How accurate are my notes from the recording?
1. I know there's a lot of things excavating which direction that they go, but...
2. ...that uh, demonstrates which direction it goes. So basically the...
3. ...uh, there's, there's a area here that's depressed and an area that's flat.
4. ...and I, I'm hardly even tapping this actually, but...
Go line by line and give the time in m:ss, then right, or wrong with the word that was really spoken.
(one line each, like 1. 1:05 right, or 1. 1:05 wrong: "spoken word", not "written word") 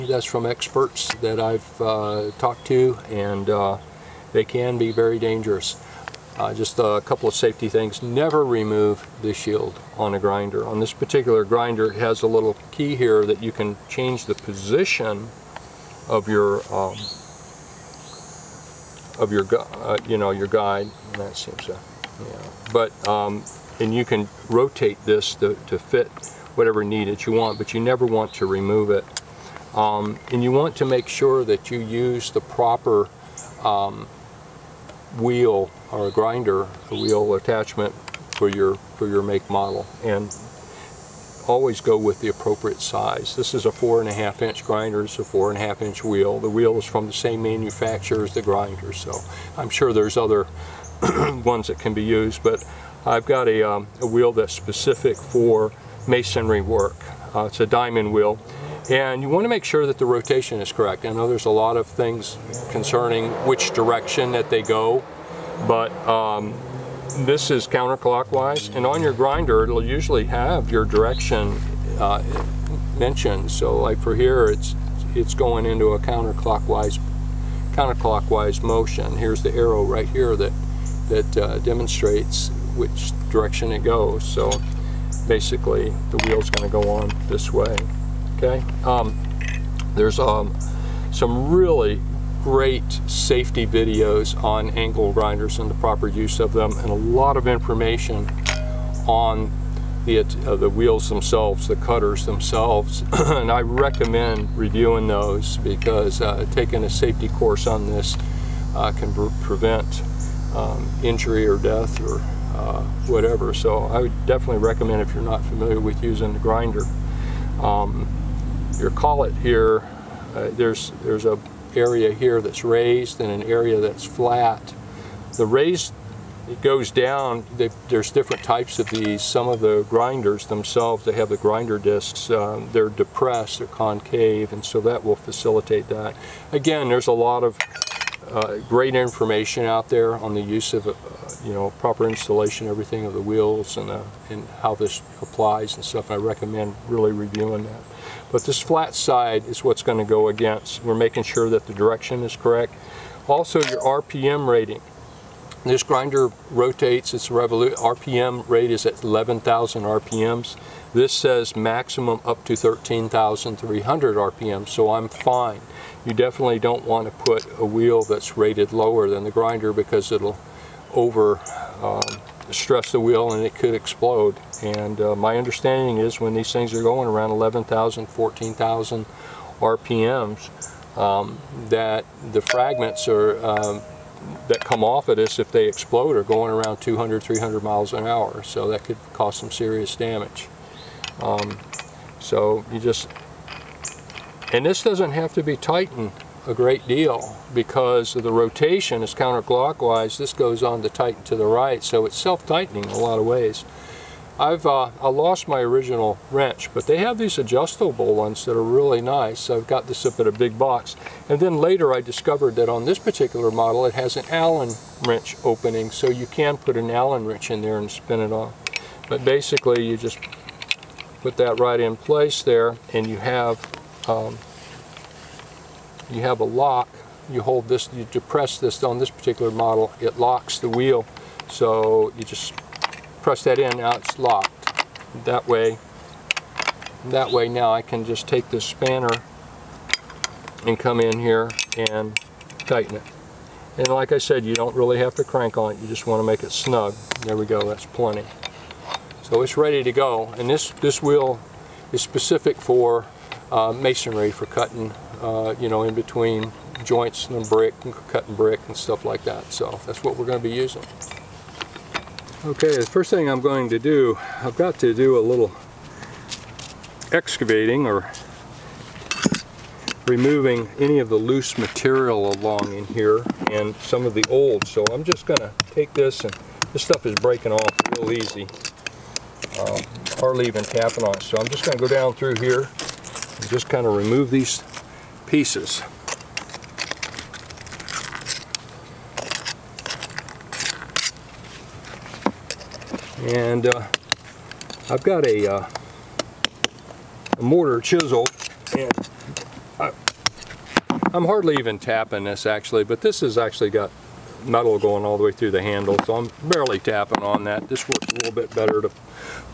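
1. 1:01 wrong: "concerning", not "excavating"
2. 1:21 right
3. 2:00 wrong: "raised", not "depressed"
4. 4:58 right.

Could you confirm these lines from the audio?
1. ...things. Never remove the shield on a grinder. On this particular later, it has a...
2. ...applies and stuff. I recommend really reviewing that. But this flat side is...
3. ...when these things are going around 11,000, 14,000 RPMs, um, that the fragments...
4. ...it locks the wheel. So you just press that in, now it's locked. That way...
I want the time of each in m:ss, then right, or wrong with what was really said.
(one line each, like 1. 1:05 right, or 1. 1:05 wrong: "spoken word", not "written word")
1. 0:07 wrong: "grinder", not "later"
2. 2:25 right
3. 2:56 right
4. 3:49 right.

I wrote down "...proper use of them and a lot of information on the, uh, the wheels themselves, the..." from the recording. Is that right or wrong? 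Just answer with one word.
right.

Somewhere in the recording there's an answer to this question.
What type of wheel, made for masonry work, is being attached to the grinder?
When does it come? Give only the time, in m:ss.
0:57.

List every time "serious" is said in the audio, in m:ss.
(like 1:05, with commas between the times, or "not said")
3:09.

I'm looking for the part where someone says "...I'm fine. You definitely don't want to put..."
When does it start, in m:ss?
2:44.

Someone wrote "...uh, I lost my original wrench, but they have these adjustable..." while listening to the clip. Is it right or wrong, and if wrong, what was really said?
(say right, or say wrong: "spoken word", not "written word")
right.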